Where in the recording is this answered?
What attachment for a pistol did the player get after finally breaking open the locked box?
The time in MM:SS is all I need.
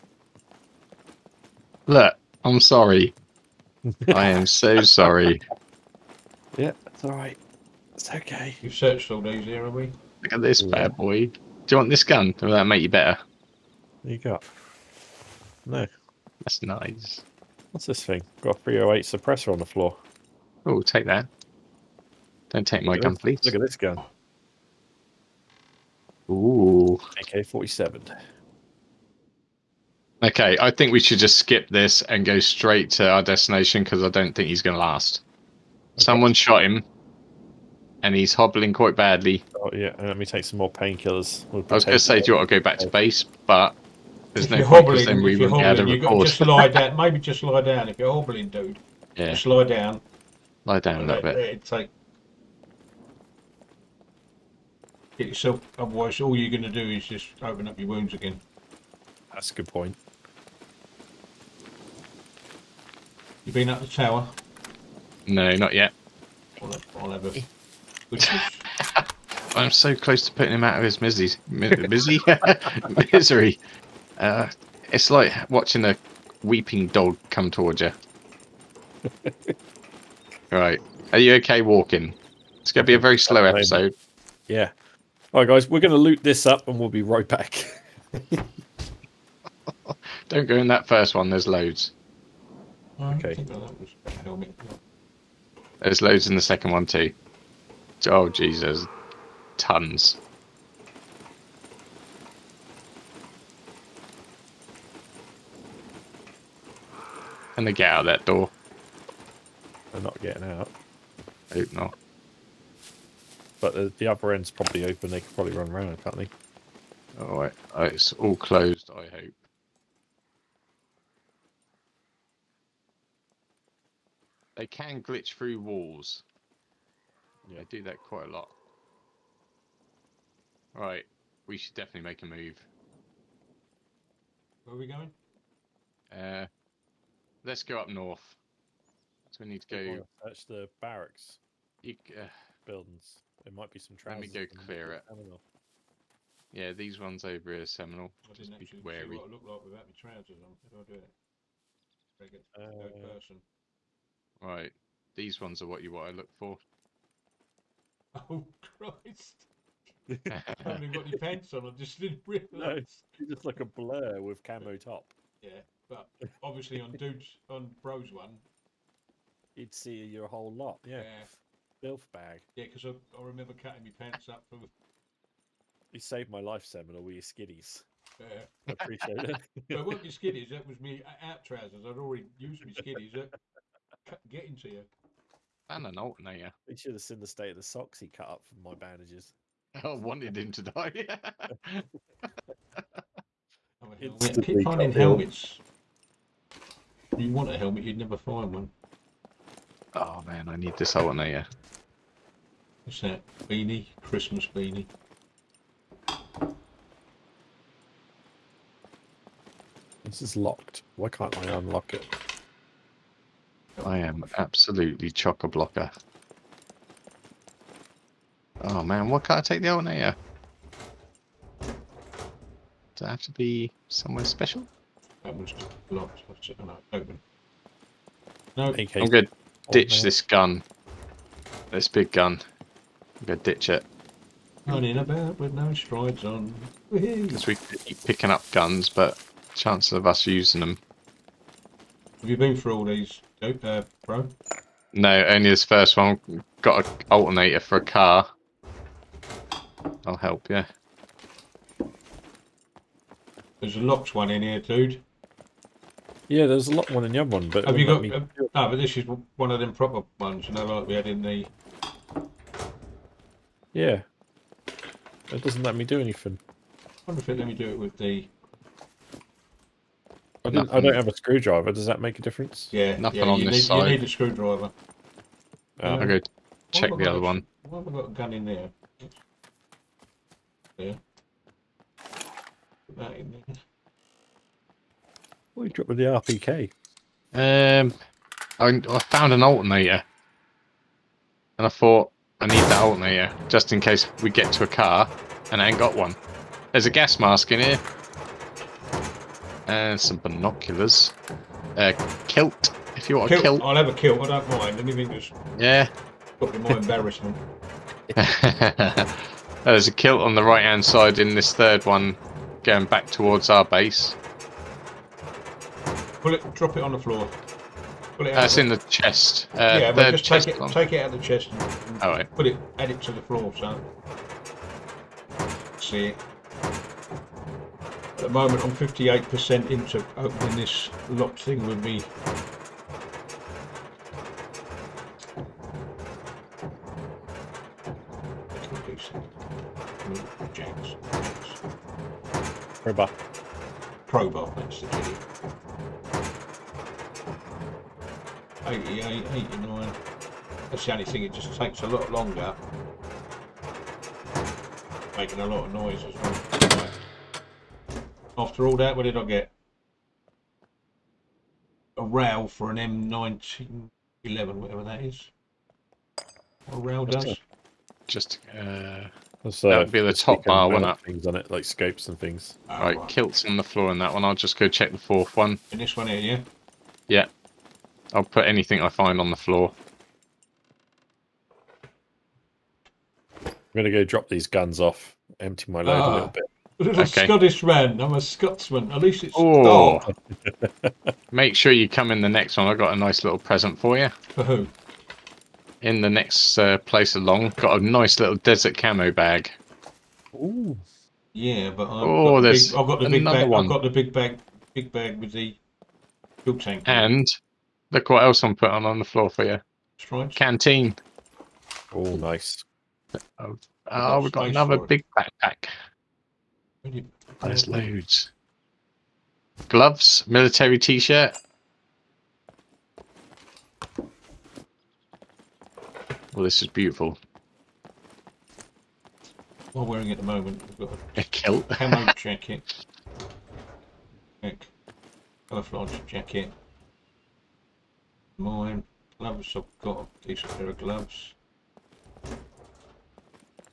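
06:02.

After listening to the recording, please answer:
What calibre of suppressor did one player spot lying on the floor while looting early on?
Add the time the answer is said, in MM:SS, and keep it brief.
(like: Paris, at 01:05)
308, at 00:18.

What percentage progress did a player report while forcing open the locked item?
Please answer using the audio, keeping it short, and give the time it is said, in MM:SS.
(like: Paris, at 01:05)
58%, at 05:28.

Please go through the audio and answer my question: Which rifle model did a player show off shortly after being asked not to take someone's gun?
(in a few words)
AK 47.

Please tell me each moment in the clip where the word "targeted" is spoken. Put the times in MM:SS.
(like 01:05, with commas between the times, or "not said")
not said.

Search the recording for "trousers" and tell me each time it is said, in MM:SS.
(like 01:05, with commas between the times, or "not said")
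02:23, 02:29, 03:01.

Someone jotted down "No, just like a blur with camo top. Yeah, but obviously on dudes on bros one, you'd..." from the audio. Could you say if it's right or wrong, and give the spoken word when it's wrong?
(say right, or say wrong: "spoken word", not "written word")
right.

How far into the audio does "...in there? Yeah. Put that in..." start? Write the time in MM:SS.
04:38.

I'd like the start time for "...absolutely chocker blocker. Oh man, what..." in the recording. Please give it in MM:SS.
03:34.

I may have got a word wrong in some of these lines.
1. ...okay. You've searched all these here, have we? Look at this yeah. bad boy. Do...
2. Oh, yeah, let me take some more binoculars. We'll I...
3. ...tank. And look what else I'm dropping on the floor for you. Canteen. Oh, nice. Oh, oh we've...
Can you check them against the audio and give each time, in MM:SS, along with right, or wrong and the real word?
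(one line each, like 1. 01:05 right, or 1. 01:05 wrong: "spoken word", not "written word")
1. 00:08 right
2. 00:39 wrong: "painkillers", not "binoculars"
3. 06:46 wrong: "putting", not "dropping".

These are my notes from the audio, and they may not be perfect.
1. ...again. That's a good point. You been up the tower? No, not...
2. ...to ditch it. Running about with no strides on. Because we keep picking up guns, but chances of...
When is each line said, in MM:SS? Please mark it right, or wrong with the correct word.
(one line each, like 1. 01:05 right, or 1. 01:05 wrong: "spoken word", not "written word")
1. 00:58 right
2. 03:53 right.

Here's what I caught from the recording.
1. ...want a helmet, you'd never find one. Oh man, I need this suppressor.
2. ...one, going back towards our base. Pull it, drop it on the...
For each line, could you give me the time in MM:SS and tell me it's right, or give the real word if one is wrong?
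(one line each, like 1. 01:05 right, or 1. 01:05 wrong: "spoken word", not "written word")
1. 03:17 wrong: "alternator", not "suppressor"
2. 05:11 right.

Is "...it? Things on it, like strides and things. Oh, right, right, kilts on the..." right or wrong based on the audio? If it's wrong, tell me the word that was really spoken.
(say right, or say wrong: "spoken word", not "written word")
wrong: "scopes", not "strides".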